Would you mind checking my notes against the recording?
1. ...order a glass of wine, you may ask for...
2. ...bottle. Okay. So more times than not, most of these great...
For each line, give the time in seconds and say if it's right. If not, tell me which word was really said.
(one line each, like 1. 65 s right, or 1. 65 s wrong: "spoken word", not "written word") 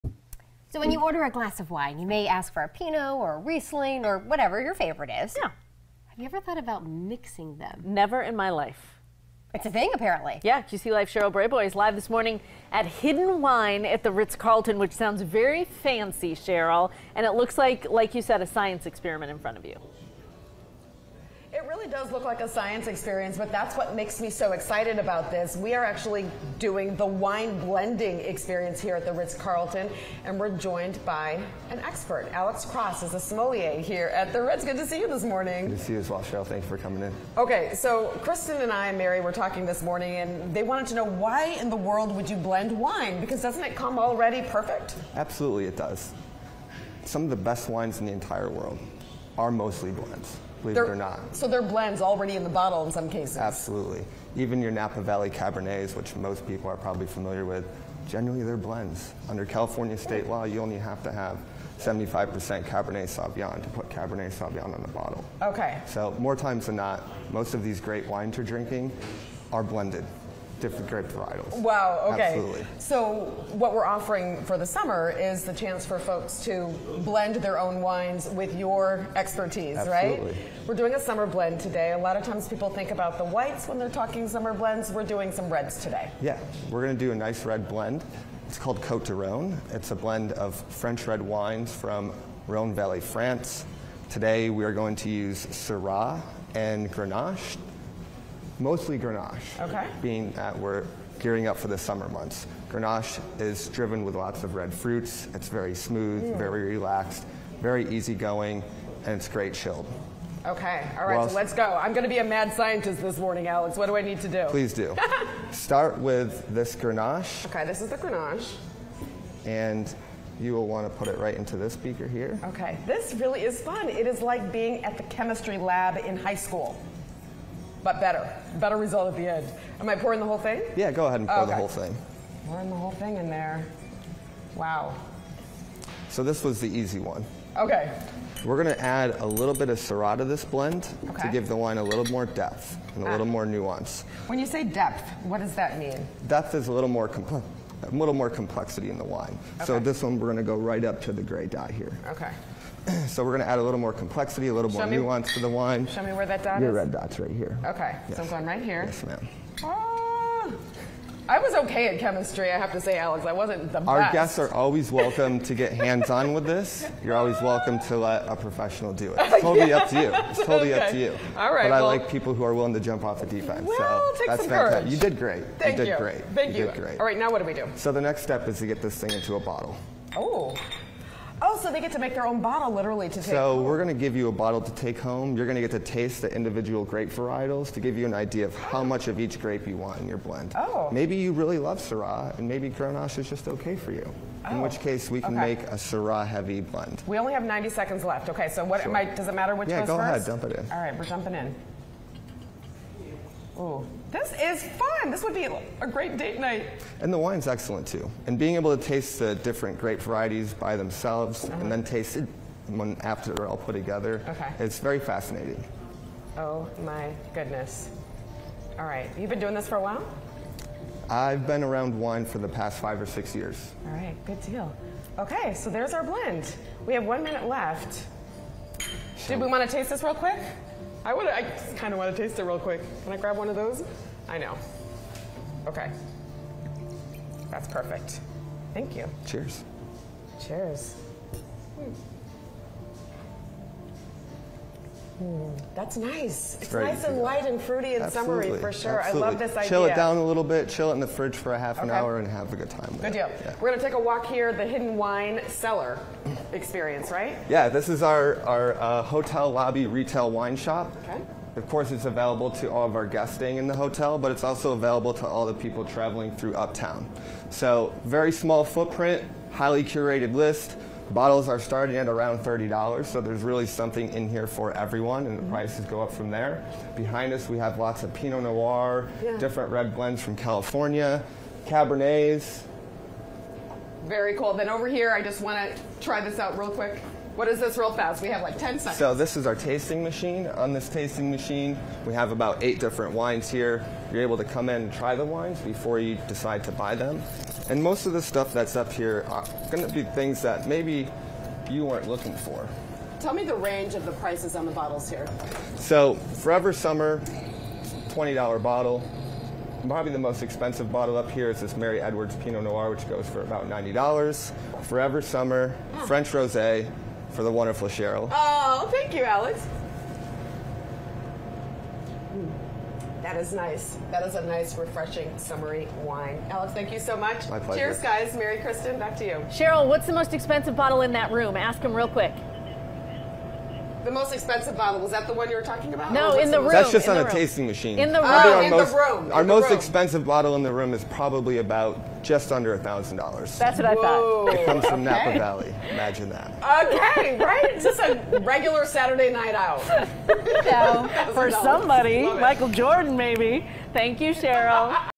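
1. 1 s right
2. 64 s right.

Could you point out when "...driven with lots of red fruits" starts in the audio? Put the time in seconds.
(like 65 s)
103 s.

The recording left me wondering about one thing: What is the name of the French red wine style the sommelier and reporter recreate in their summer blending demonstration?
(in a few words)
Cote de Rhone.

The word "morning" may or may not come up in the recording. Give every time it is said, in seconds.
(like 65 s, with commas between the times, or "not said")
12 s, 35 s, 39 s, 113 s.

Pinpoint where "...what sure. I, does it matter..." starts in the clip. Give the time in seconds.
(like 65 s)
198 s.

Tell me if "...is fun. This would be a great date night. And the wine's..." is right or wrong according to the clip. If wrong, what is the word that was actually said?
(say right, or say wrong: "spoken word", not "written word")
right.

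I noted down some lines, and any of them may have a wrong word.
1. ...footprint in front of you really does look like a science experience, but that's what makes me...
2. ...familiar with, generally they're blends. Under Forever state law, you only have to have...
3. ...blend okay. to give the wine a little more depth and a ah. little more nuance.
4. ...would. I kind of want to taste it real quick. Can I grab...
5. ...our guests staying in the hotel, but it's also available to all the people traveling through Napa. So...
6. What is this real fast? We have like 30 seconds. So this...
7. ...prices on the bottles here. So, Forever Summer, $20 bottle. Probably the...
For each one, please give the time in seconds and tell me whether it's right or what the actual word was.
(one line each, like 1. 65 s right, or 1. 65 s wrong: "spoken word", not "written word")
1. 18 s wrong: "experiment", not "footprint"
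2. 57 s wrong: "California", not "Forever"
3. 140 s right
4. 231 s right
5. 262 s wrong: "Uptown", not "Napa"
6. 287 s wrong: "10", not "30"
7. 304 s right.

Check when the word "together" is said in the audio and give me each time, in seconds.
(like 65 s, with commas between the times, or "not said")
213 s.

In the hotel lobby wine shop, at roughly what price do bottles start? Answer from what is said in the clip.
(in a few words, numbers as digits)
$30.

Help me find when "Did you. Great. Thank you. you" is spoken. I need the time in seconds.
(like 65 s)
175 s.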